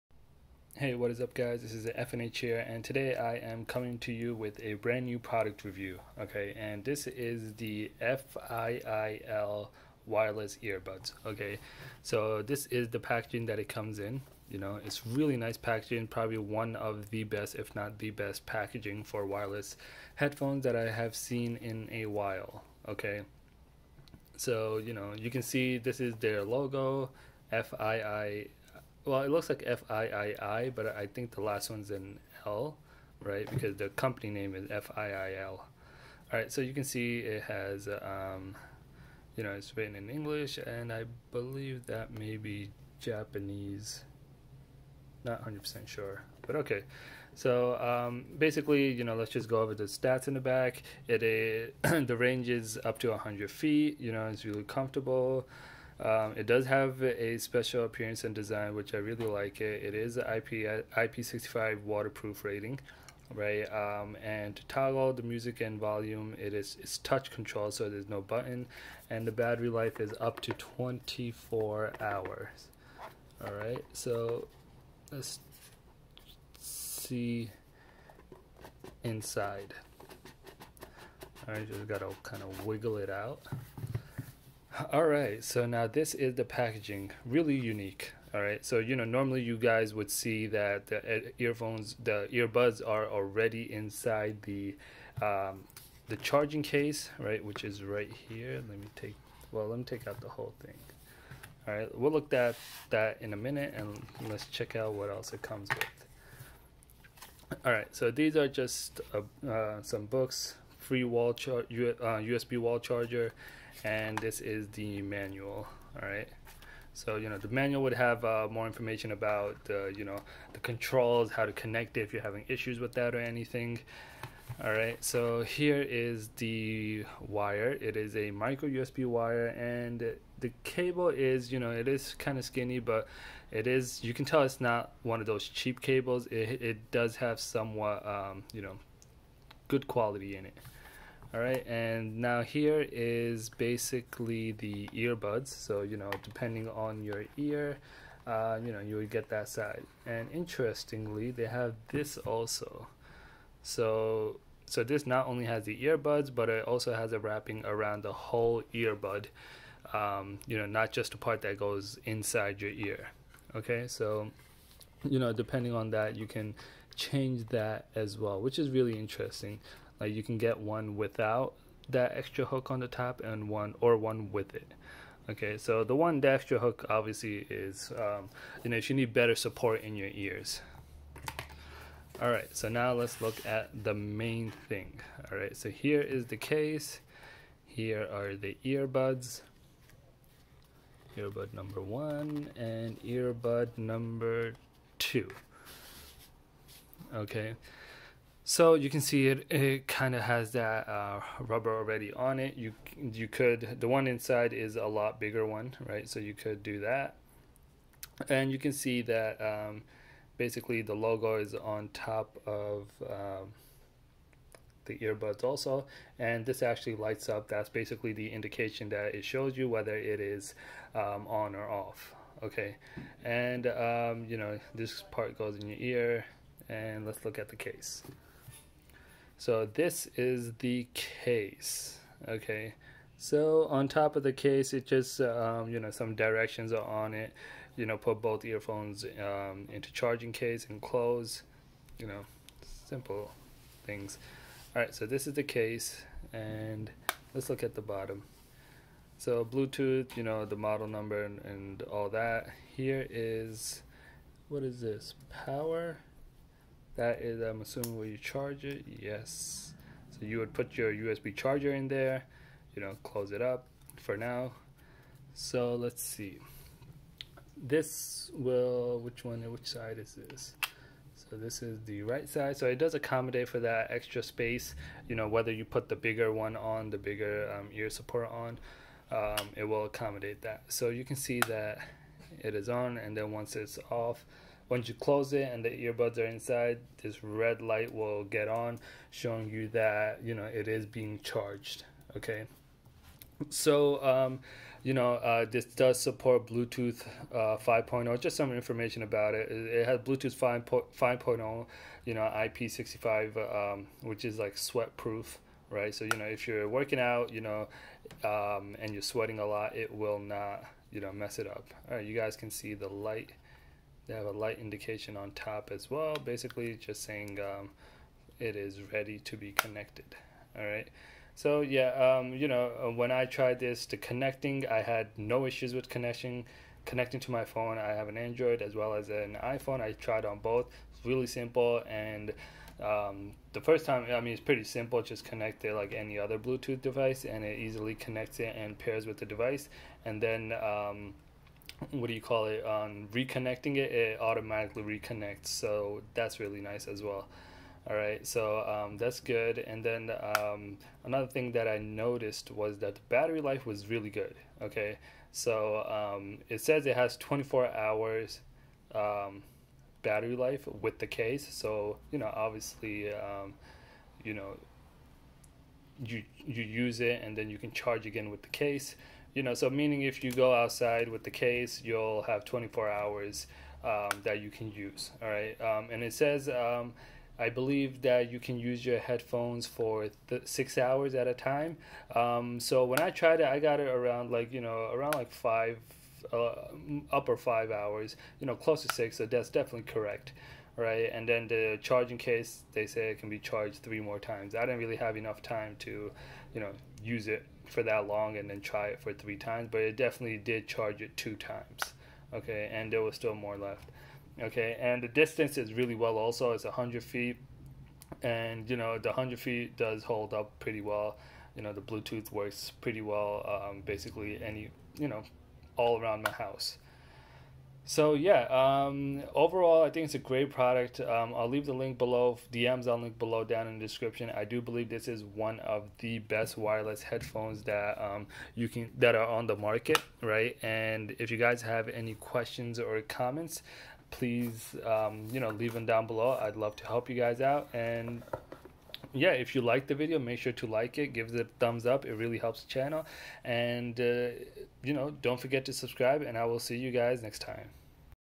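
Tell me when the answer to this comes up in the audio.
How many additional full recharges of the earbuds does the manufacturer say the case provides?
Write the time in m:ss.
6:33.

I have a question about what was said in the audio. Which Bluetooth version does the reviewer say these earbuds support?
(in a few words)
5.0.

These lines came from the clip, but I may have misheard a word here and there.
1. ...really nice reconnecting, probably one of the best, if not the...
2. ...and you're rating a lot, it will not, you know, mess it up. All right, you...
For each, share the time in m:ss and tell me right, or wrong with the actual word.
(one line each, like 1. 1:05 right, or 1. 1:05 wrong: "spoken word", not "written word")
1. 0:15 wrong: "packaging", not "reconnecting"
2. 5:08 wrong: "sweating", not "rating".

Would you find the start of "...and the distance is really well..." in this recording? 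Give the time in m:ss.
6:44.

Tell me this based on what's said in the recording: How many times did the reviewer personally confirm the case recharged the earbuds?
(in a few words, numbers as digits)
2.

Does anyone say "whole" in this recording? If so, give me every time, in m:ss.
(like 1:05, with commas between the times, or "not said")
1:40, 2:38.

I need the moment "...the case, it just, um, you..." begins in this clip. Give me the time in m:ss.
3:54.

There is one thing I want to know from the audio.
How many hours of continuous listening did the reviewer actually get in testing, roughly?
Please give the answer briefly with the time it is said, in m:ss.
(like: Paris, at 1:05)
upper 5 hours, at 6:27.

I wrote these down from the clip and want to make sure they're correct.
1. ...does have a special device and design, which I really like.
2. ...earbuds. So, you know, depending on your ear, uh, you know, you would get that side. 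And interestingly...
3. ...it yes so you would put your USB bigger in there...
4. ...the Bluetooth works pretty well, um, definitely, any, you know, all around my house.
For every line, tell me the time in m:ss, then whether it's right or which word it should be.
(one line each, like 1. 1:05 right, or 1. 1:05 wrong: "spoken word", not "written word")
1. 0:56 wrong: "appearance", not "device"
2. 2:24 right
3. 4:18 wrong: "charger", not "bigger"
4. 6:51 wrong: "basically", not "definitely".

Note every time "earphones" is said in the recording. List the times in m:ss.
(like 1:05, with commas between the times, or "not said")
1:31, 3:58.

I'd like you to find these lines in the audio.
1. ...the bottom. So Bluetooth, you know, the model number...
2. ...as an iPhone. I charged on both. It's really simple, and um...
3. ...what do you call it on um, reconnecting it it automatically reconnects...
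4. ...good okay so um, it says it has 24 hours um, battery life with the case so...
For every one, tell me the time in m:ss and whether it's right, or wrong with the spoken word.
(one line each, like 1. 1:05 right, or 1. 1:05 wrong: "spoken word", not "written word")
1. 4:07 right
2. 5:28 wrong: "tried", not "charged"
3. 5:41 right
4. 5:54 right.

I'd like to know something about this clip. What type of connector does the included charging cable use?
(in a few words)
micro USB.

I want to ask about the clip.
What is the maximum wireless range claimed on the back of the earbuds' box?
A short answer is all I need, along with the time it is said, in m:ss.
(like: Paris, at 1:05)
100 feet, at 0:51.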